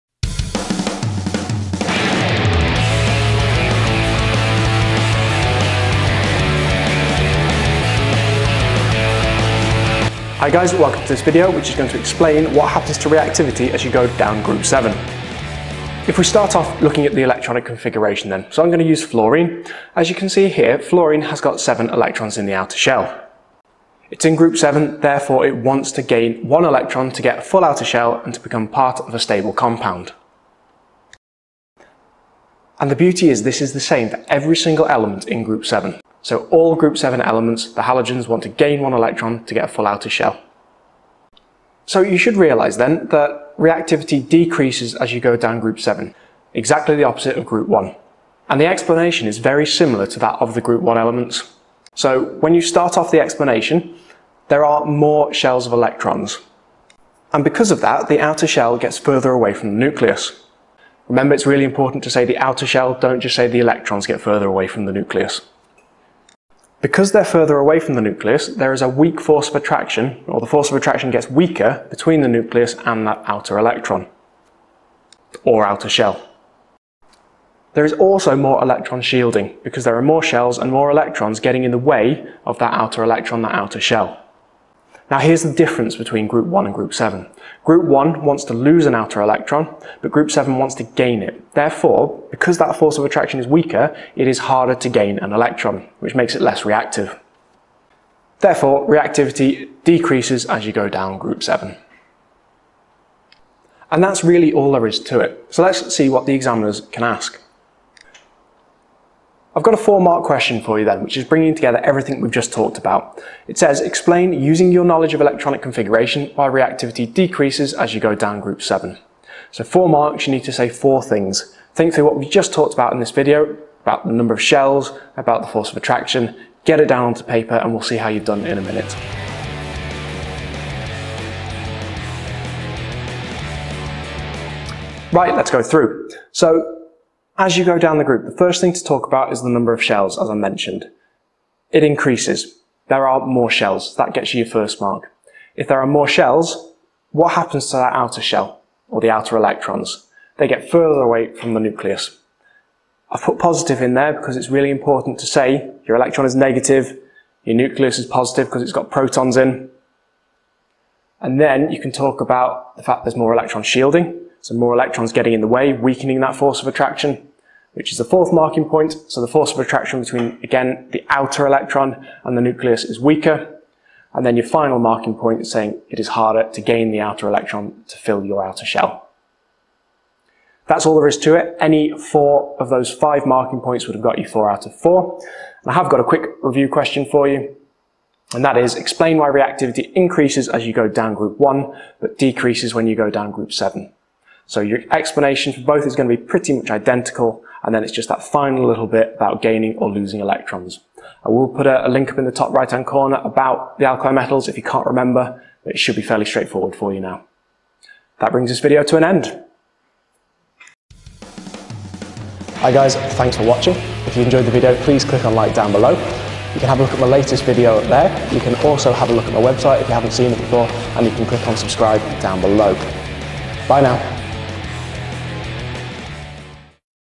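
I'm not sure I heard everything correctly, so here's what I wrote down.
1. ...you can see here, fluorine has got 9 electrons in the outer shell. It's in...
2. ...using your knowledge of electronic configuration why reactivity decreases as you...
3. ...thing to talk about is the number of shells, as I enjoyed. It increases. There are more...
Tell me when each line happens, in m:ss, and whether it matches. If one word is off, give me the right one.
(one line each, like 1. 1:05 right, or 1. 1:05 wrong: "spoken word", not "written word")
1. 0:20 wrong: "7", not "9"
2. 1:54 right
3. 2:18 wrong: "mentioned", not "enjoyed".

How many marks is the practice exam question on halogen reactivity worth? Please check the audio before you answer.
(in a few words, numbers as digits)
4.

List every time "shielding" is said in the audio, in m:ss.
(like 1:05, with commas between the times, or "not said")
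1:19, 2:43.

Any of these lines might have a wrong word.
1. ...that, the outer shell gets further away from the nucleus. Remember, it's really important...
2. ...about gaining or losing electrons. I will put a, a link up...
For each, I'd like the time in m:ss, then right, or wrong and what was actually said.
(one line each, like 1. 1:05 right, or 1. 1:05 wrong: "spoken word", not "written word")
1. 0:57 right
2. 3:19 right.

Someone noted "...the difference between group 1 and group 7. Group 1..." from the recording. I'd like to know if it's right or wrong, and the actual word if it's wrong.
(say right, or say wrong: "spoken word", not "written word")
right.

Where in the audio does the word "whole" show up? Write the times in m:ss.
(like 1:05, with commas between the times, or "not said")
not said.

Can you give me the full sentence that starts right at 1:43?
And that's really all there is to it.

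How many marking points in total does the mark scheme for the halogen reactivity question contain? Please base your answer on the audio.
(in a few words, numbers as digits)
5.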